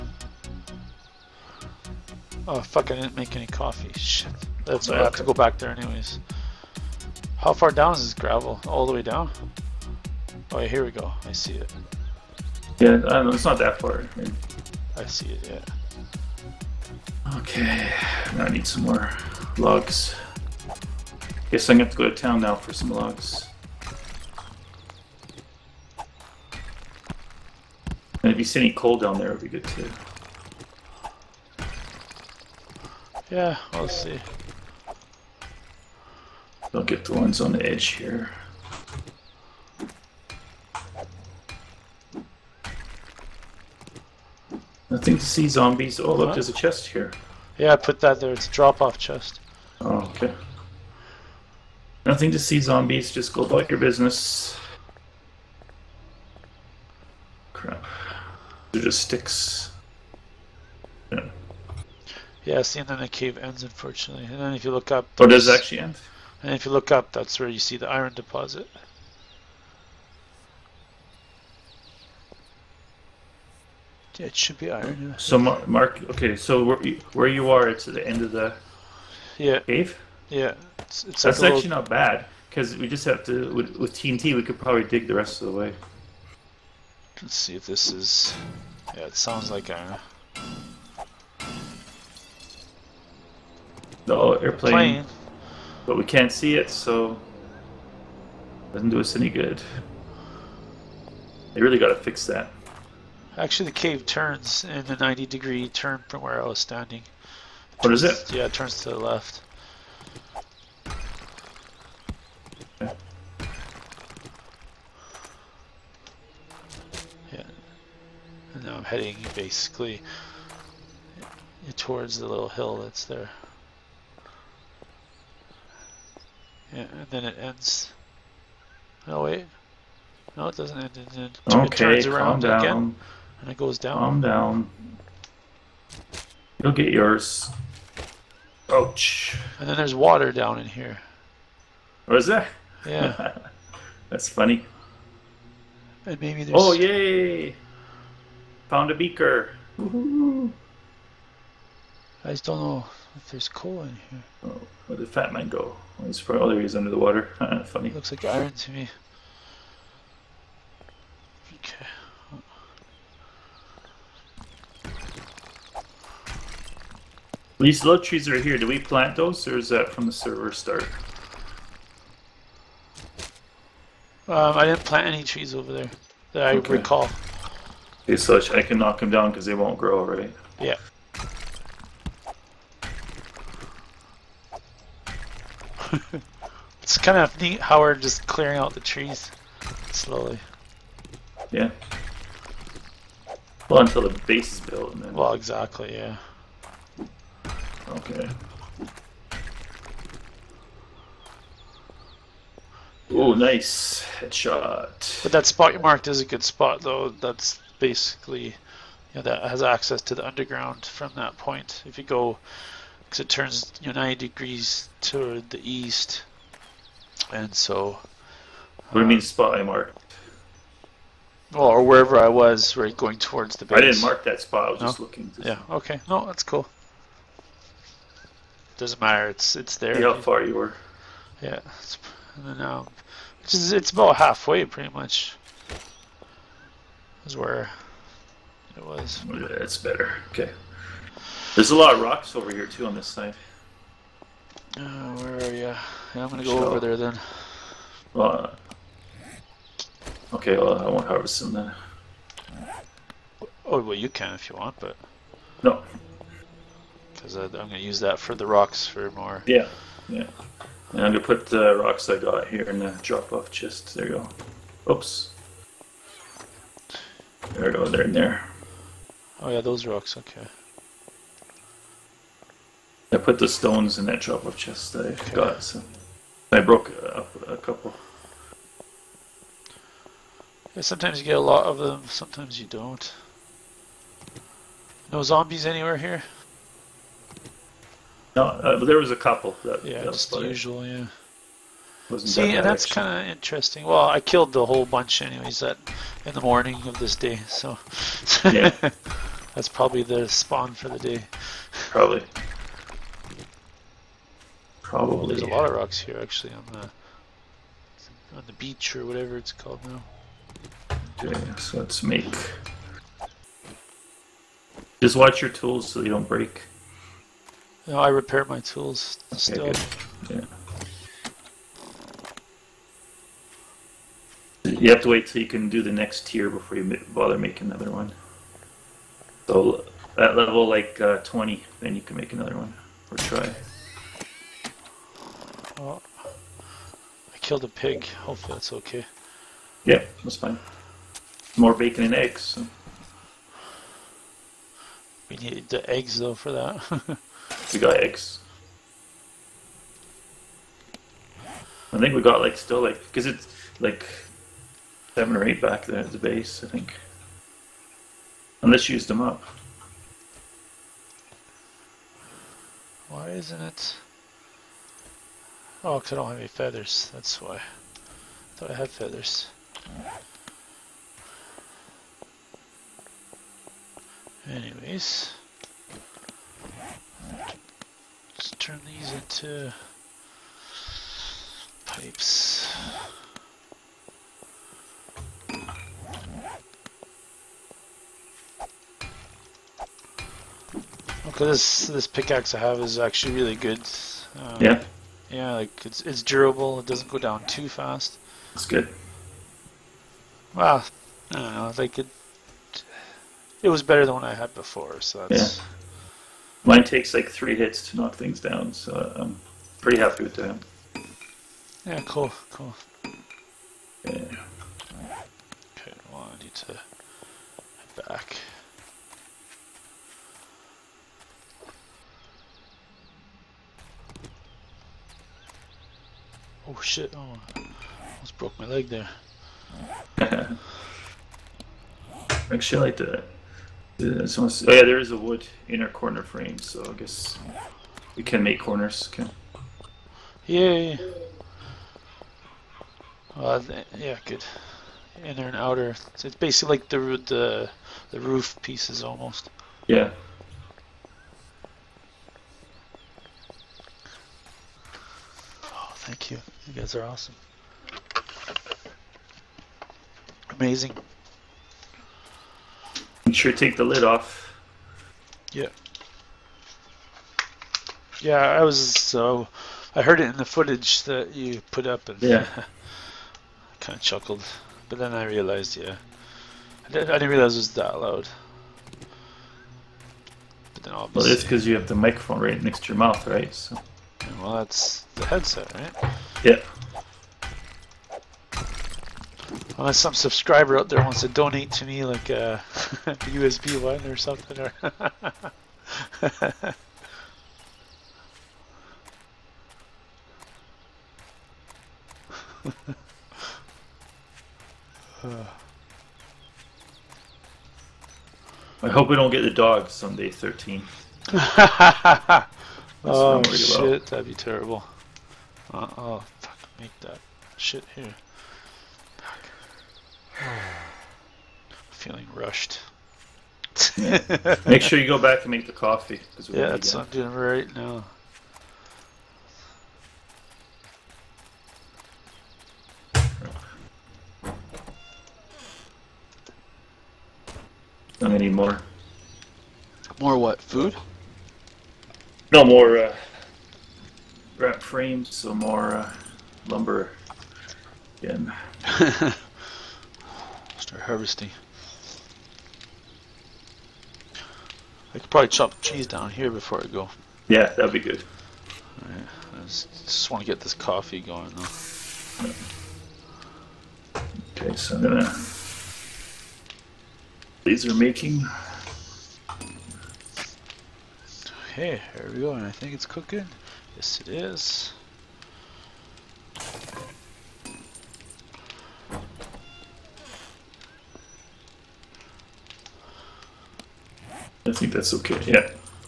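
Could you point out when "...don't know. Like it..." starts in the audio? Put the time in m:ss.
6:41.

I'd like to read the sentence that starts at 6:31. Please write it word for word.
Okay, this this pickaxe I have is actually really good.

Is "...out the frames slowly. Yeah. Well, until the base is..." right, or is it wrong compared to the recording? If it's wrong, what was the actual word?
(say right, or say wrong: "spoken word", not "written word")
wrong: "trees", not "frames".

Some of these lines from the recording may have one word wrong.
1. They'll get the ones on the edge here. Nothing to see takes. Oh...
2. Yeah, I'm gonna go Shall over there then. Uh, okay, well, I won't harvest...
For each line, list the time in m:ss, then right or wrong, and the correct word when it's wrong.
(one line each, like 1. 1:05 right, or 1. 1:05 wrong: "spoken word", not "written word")
1. 0:36 wrong: "zombies", not "takes"
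2. 4:05 right.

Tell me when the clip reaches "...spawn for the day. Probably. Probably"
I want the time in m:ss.
5:00.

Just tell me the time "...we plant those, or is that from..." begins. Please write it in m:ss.
2:48.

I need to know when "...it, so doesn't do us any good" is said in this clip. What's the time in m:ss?
1:36.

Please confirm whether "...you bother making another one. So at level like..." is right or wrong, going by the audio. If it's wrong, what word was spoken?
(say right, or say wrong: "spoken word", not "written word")
right.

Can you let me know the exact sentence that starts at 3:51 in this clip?
It's, and then, um, which is it's about halfway, pretty much.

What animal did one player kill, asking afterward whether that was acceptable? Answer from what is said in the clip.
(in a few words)
pig.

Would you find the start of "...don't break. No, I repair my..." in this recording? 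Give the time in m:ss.
5:16.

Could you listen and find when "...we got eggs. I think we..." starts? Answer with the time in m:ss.
5:47.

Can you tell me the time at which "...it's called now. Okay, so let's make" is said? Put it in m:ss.
5:09.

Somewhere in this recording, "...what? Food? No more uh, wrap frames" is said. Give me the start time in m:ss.
9:00.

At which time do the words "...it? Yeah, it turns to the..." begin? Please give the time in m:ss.
1:48.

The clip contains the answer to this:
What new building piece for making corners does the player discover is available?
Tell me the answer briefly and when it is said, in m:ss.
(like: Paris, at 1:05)
wood inner corner frame, at 7:15.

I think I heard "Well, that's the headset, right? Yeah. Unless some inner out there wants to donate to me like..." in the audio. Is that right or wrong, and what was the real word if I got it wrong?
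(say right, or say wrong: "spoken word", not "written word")
wrong: "subscriber", not "inner".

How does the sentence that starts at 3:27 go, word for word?
That's basically, you know, that has access to the underground from that point.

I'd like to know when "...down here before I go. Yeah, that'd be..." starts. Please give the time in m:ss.
9:16.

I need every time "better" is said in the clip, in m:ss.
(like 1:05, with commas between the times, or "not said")
3:59, 6:43.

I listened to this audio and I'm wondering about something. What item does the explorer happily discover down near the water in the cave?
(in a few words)
a beaker.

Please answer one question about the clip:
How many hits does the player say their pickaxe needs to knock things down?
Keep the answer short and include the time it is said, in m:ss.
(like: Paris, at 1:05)
3, at 6:47.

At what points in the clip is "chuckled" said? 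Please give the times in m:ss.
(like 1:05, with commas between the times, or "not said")
7:54.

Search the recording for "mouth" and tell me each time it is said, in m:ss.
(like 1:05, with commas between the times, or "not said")
8:02.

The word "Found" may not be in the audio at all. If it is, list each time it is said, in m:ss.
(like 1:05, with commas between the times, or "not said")
2:28.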